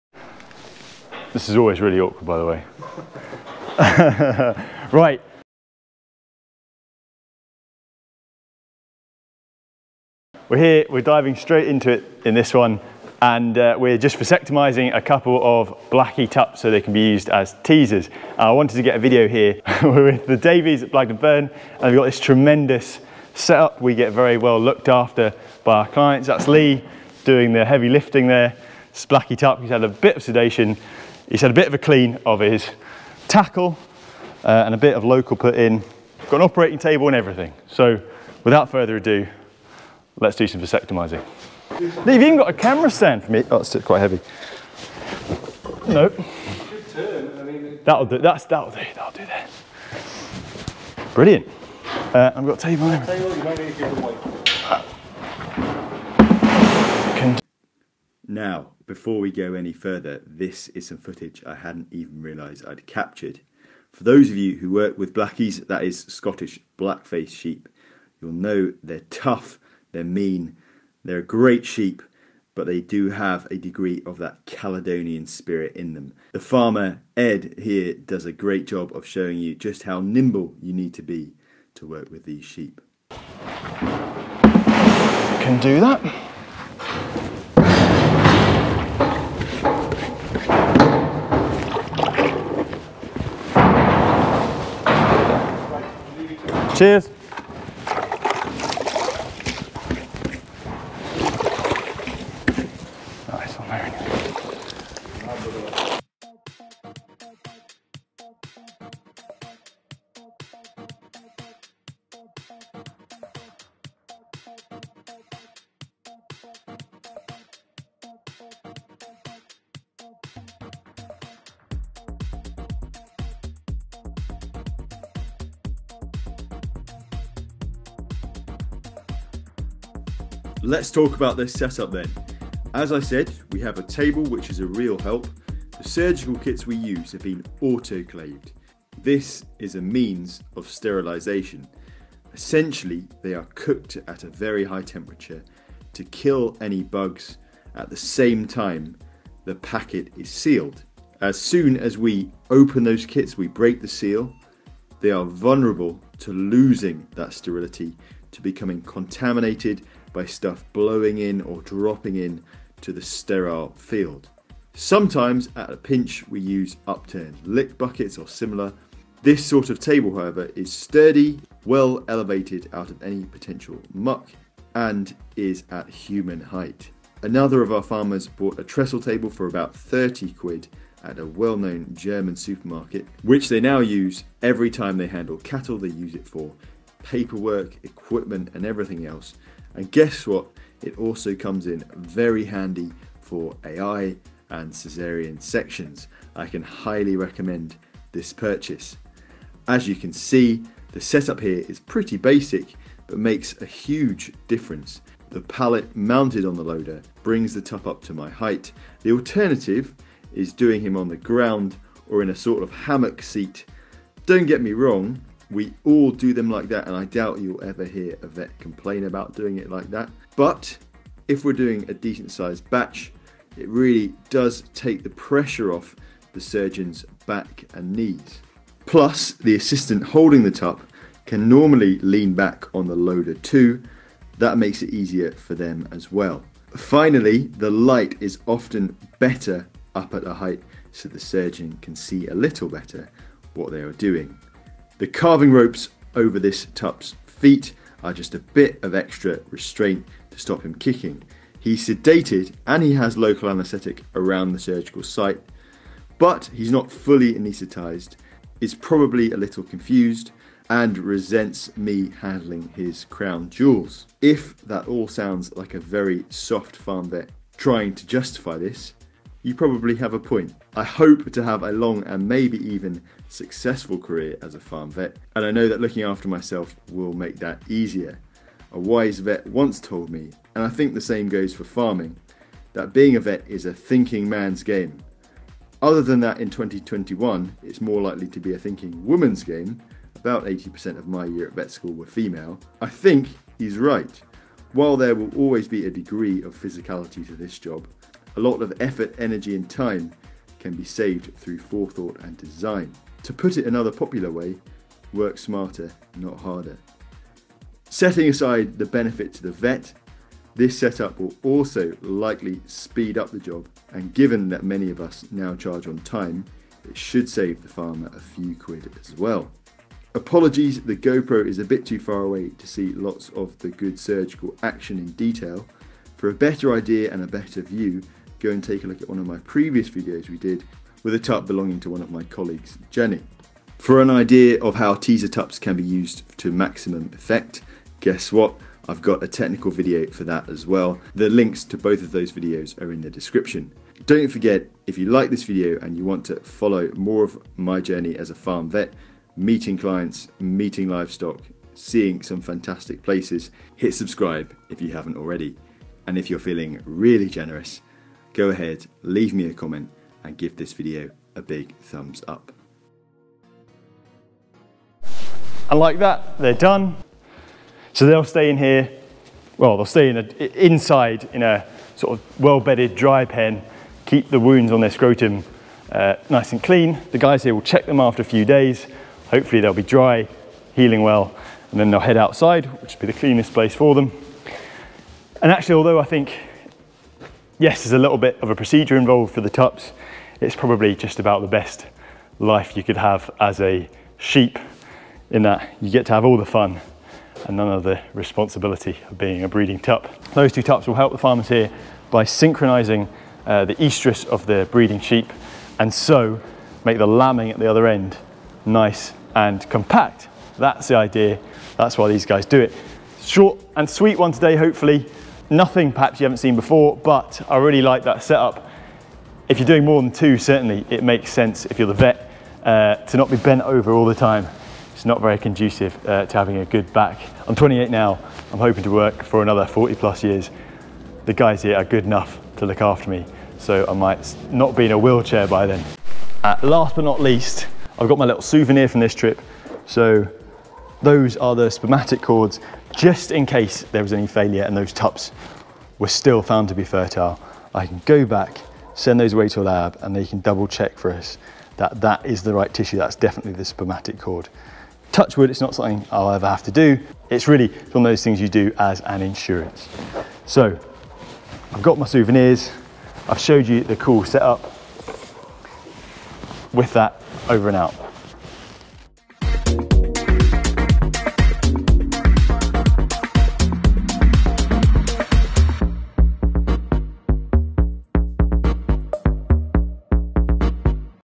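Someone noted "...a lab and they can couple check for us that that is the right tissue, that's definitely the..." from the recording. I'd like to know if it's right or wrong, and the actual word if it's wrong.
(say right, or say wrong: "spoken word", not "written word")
wrong: "double", not "couple".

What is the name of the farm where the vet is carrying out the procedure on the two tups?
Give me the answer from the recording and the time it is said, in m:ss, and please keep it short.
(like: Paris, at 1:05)
Blagden Burn, at 0:20.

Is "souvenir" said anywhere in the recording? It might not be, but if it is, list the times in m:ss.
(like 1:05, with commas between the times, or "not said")
7:18, 7:42.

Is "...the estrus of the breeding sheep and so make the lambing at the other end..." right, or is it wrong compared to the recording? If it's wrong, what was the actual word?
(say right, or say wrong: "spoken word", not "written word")
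right.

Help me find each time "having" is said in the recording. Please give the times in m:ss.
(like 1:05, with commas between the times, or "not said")
7:06.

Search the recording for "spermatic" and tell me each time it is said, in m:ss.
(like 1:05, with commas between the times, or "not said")
7:21, 7:33.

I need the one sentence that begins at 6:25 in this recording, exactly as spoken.
And actually, although I think yes, there's a little bit of a procedure involved for the tups.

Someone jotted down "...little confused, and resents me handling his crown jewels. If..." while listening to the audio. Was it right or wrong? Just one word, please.
right.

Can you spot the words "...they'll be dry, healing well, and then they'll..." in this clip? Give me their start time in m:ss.
6:19.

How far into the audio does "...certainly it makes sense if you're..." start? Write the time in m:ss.
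7:00.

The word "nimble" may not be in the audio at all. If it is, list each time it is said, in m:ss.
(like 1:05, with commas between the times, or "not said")
1:19.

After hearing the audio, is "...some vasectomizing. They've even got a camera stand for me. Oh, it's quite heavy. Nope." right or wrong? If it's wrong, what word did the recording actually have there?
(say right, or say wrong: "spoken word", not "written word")
right.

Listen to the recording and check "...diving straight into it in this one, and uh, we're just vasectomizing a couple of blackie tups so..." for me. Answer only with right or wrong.
right.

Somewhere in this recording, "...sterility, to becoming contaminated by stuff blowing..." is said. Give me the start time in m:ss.
2:37.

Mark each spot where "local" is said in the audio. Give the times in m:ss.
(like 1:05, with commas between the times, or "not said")
0:35, 4:13.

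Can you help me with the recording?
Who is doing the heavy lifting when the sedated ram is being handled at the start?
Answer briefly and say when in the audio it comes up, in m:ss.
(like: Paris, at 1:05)
Lee, at 0:26.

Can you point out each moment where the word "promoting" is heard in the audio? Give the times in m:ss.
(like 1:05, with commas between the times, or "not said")
not said.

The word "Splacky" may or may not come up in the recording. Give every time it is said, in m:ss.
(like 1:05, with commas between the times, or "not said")
0:28.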